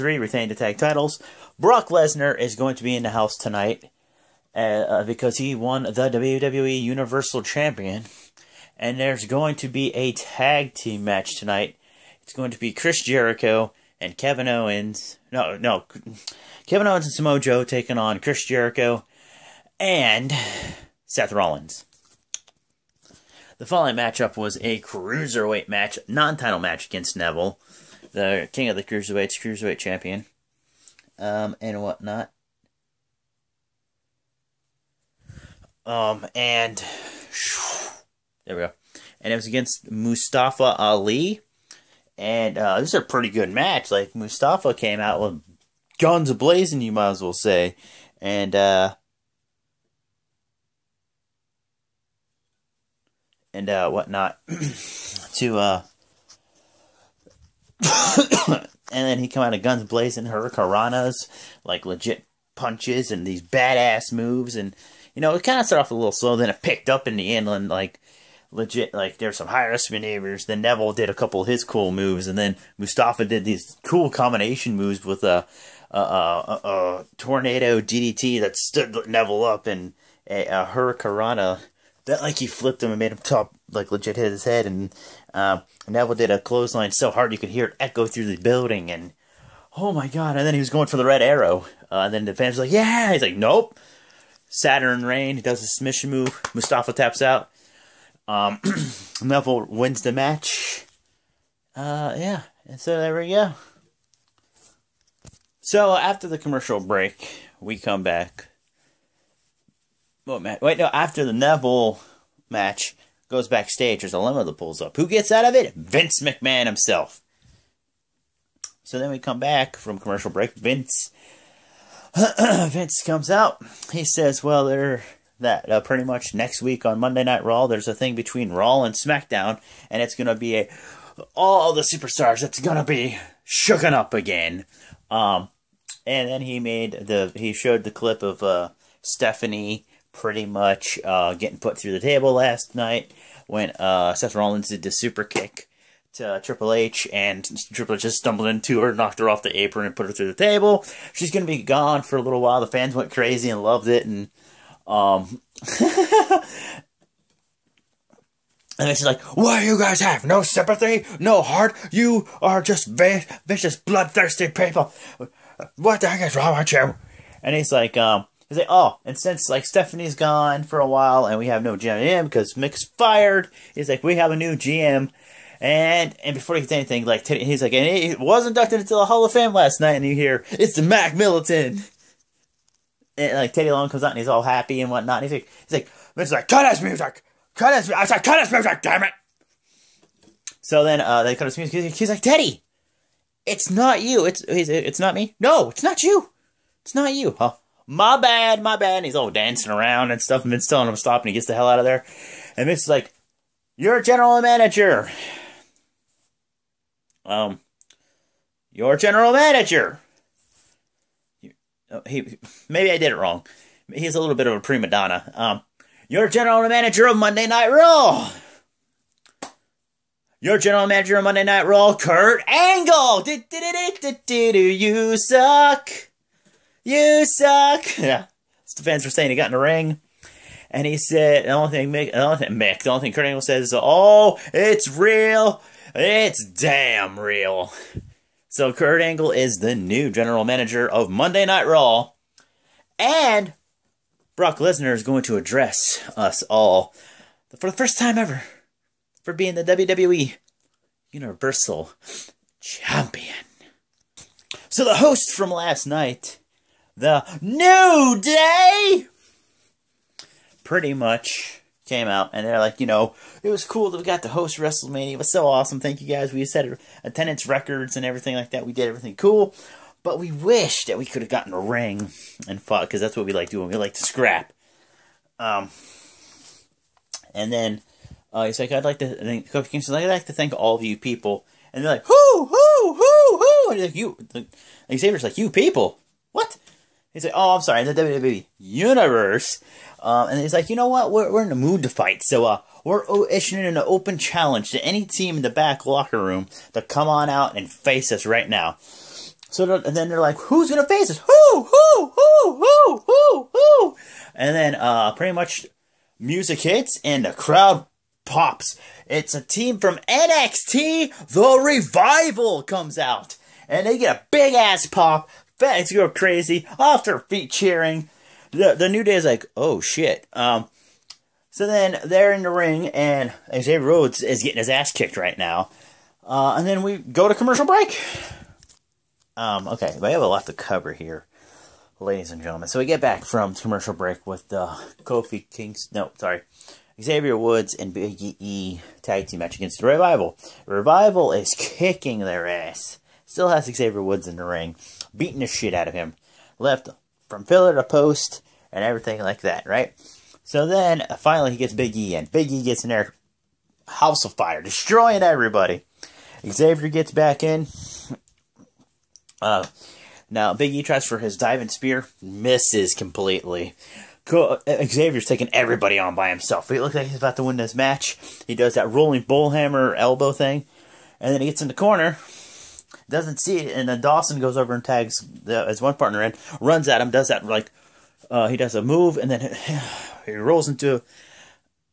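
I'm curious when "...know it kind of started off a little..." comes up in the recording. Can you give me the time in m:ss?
1:05.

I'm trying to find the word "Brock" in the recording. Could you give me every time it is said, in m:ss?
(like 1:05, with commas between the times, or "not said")
0:01, 4:04.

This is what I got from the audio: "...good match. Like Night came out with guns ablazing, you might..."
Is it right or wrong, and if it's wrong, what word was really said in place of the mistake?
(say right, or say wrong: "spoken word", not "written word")
wrong: "Mustafa", not "Night".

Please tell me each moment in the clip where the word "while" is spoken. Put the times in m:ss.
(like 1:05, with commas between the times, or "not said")
2:32, 2:50.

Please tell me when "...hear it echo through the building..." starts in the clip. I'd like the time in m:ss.
1:27.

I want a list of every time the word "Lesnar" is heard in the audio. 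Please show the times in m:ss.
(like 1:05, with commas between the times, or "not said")
0:01, 4:04.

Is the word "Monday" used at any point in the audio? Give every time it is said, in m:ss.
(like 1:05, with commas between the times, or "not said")
2:06, 3:37, 3:41, 4:01.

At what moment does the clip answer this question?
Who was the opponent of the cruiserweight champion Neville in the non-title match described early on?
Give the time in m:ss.
0:39.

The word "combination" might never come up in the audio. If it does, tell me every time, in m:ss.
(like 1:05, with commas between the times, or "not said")
1:14.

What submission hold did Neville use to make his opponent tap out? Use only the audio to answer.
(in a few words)
Saturn Rain.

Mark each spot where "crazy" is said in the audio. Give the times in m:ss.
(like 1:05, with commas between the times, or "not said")
2:33, 5:16.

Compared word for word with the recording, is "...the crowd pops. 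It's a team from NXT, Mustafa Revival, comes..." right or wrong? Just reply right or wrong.
wrong.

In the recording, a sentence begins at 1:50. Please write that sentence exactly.
Wait, no, after the Neville match goes backstage, there's a limo that pulls up.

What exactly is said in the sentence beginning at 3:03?
And like Teddy Long comes out and he's all happy and whatnot.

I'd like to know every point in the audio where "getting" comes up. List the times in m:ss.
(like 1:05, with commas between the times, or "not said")
2:21, 5:24.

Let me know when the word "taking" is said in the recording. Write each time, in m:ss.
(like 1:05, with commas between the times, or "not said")
0:17, 6:05.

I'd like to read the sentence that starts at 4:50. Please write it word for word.
Um, and he's like, you know what?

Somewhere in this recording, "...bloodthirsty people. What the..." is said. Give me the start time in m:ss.
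2:43.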